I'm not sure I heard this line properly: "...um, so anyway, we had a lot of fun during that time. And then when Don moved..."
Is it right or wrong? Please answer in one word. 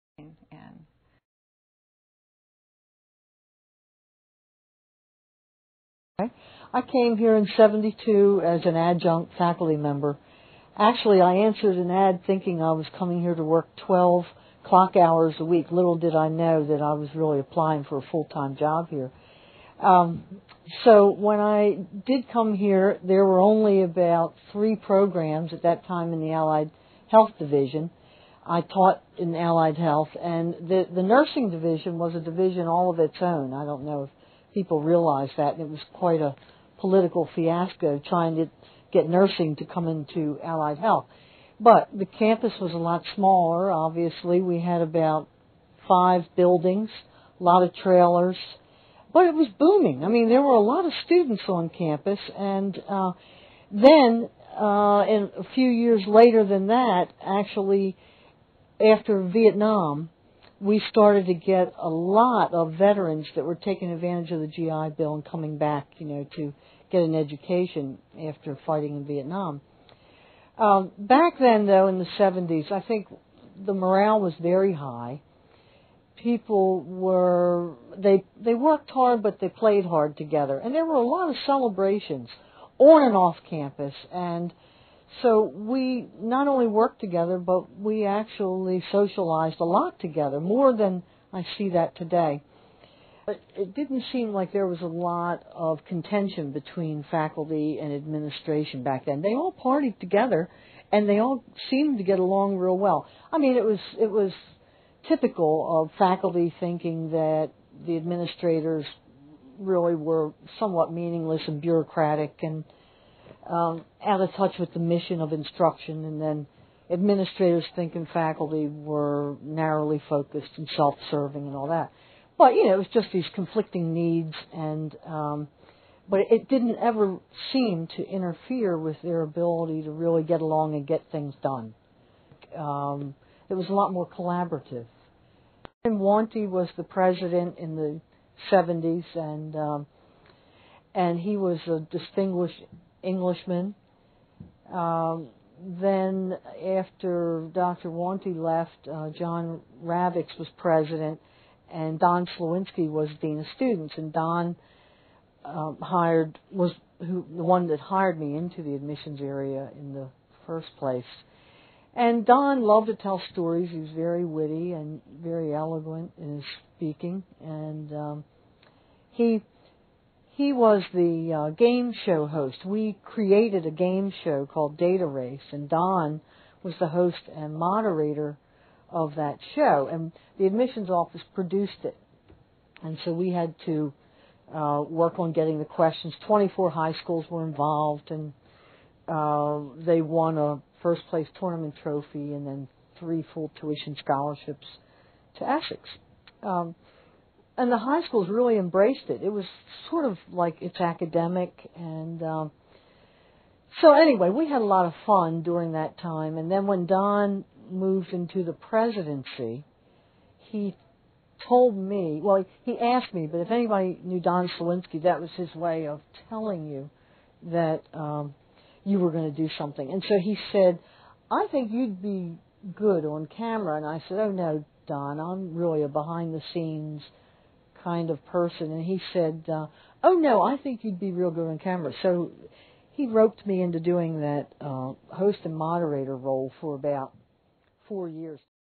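right.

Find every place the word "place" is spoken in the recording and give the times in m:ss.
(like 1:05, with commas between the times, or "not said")
2:40, 3:11.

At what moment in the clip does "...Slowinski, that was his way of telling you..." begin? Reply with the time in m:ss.
3:34.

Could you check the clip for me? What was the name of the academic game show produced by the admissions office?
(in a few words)
Data Race.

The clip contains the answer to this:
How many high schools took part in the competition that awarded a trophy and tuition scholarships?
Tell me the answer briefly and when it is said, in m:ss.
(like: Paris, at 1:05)
24, at 3:06.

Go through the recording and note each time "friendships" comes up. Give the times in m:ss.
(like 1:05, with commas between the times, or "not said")
not said.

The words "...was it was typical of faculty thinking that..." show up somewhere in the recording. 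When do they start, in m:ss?
1:43.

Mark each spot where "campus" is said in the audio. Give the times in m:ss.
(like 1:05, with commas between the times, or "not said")
0:42, 0:51, 1:23.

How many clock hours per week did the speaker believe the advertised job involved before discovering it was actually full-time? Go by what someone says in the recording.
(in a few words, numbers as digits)
12.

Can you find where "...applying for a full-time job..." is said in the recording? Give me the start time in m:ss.
0:17.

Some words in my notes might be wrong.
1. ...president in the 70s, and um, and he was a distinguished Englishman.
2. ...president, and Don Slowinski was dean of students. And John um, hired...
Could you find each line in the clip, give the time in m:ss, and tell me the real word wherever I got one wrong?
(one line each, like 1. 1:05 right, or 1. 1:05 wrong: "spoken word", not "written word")
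1. 2:16 right
2. 2:30 wrong: "Don", not "John".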